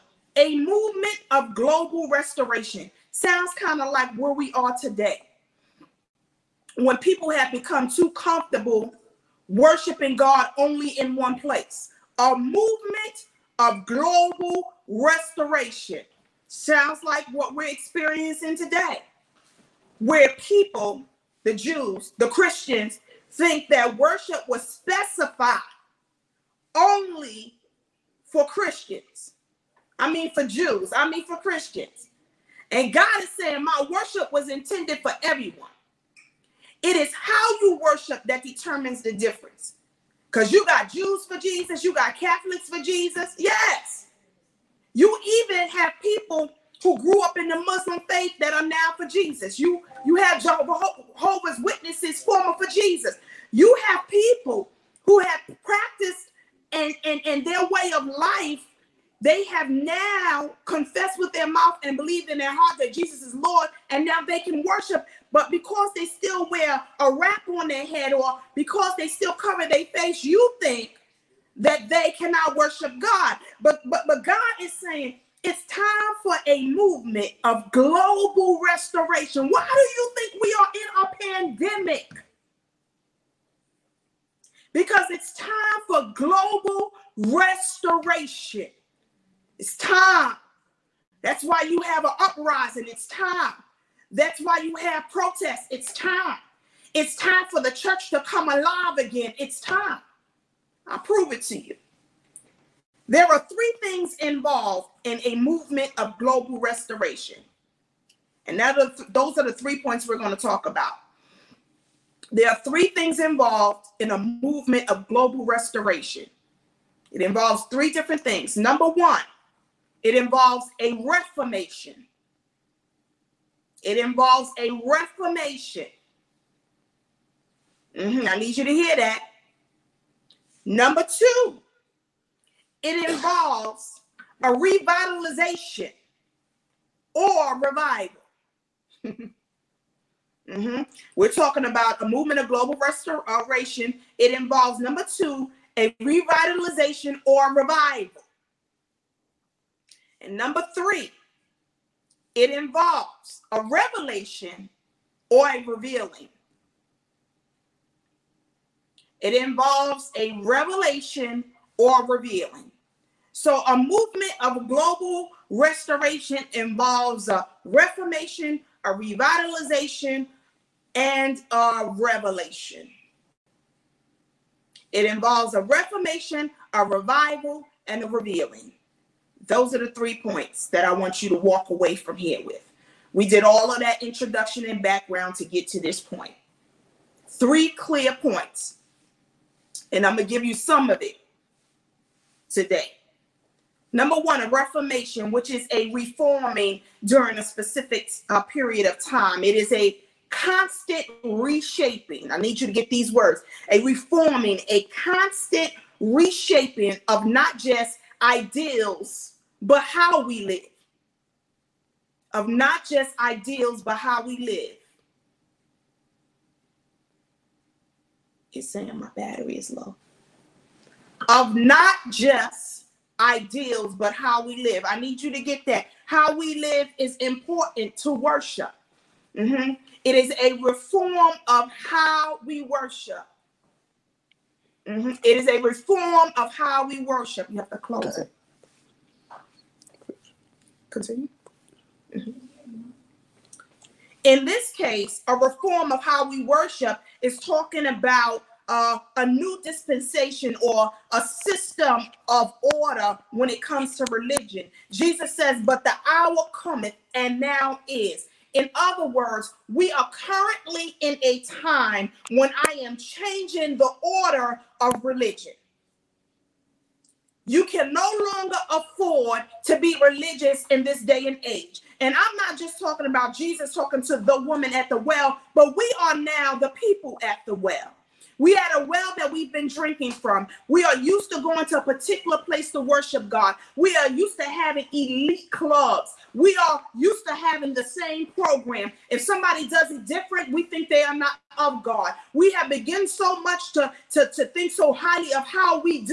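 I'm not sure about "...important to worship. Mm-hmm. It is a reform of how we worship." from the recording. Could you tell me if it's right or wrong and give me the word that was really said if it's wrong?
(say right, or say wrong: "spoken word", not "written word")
right.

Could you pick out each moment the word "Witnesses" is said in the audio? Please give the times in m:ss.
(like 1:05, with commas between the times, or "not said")
0:51.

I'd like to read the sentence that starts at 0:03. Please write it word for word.
Sounds kind of like where we are today.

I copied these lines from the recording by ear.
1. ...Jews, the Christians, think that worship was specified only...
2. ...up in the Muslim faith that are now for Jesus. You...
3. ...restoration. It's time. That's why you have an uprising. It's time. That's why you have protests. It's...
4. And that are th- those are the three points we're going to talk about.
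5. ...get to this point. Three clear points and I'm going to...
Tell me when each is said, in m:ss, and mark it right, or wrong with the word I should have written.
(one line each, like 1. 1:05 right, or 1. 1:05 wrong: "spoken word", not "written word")
1. 0:21 right
2. 0:47 right
3. 1:27 right
4. 1:48 right
5. 3:05 right.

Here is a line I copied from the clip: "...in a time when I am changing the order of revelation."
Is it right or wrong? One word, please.
wrong.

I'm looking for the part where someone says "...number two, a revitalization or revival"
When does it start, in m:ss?
2:24.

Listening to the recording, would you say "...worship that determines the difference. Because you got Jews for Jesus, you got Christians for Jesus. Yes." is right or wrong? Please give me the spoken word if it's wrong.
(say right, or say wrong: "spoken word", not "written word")
wrong: "Catholics", not "Christians".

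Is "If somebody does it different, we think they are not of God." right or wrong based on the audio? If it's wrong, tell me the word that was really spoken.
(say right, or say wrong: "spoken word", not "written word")
right.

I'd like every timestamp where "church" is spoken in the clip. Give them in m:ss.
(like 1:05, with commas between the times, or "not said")
1:37.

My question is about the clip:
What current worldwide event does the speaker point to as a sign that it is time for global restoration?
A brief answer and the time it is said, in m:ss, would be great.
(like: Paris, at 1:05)
A pandemic, at 1:21.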